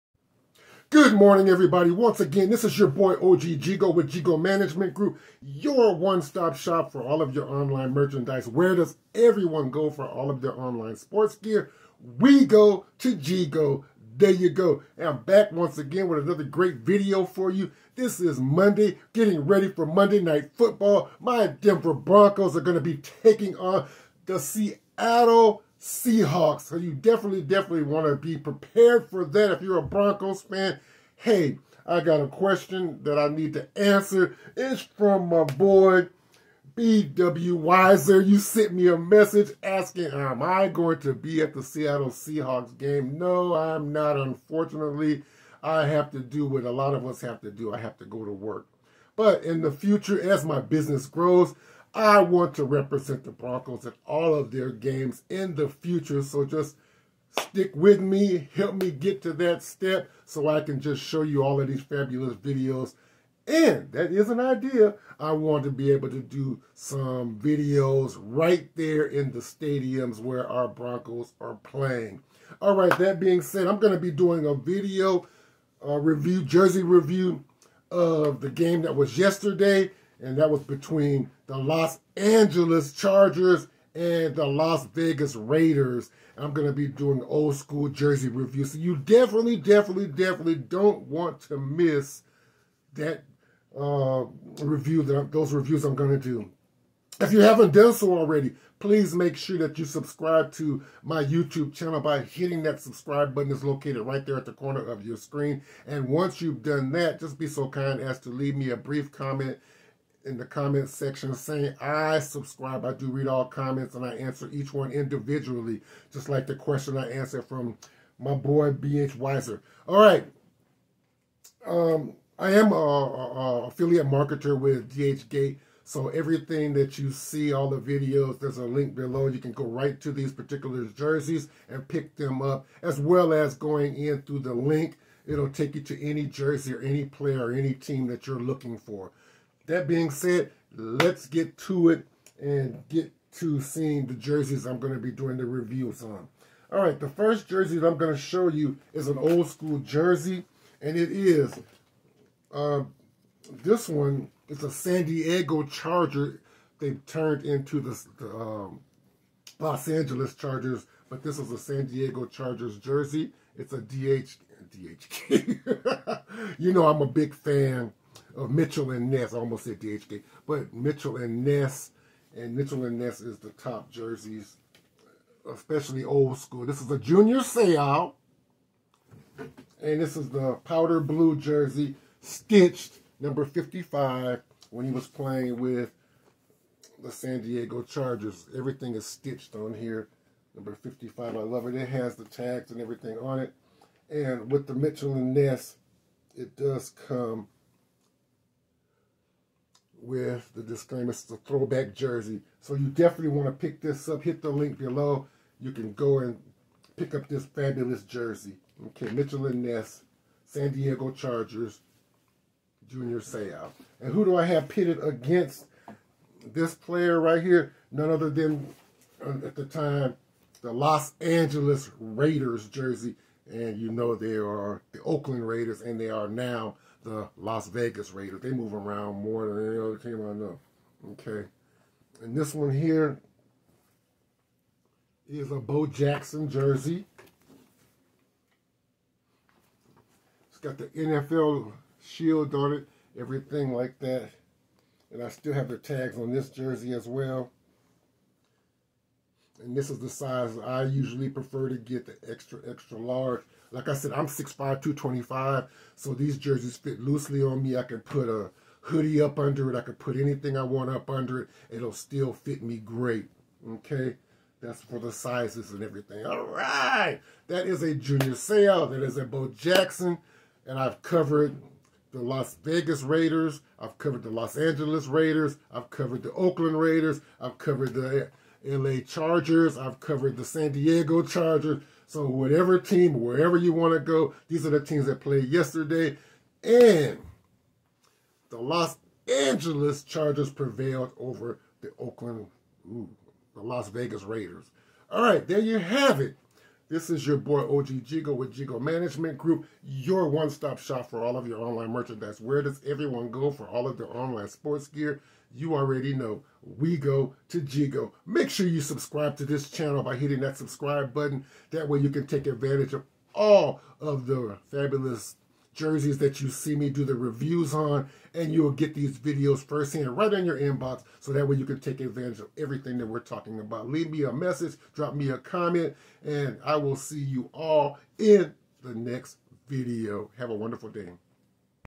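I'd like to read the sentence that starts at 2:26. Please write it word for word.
All right, the first jersey that I'm going to show you is an old school jersey, and it is uh, this one.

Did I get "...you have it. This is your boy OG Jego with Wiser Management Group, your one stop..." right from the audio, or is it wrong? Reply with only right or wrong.
wrong.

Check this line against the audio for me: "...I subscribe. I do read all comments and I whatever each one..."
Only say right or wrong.
wrong.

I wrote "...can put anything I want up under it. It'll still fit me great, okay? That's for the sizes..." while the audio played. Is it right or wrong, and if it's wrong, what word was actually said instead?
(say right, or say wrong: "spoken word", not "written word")
right.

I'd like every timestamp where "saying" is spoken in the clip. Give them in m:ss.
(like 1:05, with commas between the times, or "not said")
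1:51.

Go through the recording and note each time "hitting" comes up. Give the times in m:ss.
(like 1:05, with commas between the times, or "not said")
1:42, 5:10.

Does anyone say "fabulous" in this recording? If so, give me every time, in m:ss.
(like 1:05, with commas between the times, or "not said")
1:01, 3:27, 5:14.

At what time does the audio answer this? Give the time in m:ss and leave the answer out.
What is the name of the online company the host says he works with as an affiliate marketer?
2:04.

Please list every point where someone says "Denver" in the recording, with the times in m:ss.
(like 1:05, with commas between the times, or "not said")
0:21.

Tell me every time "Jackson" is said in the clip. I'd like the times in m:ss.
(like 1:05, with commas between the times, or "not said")
3:55, 4:29.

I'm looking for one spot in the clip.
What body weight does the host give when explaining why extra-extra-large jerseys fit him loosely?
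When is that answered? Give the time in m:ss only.
4:14.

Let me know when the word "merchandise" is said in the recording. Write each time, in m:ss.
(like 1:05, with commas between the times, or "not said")
0:07, 5:01.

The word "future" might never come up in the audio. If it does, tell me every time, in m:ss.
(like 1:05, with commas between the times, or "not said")
0:49, 0:55.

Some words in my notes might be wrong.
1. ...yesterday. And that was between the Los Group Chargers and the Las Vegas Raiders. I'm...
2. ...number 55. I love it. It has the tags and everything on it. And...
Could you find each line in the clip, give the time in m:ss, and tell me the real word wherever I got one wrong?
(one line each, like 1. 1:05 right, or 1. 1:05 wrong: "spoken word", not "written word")
1. 1:19 wrong: "Angeles", not "Group"
2. 3:10 right.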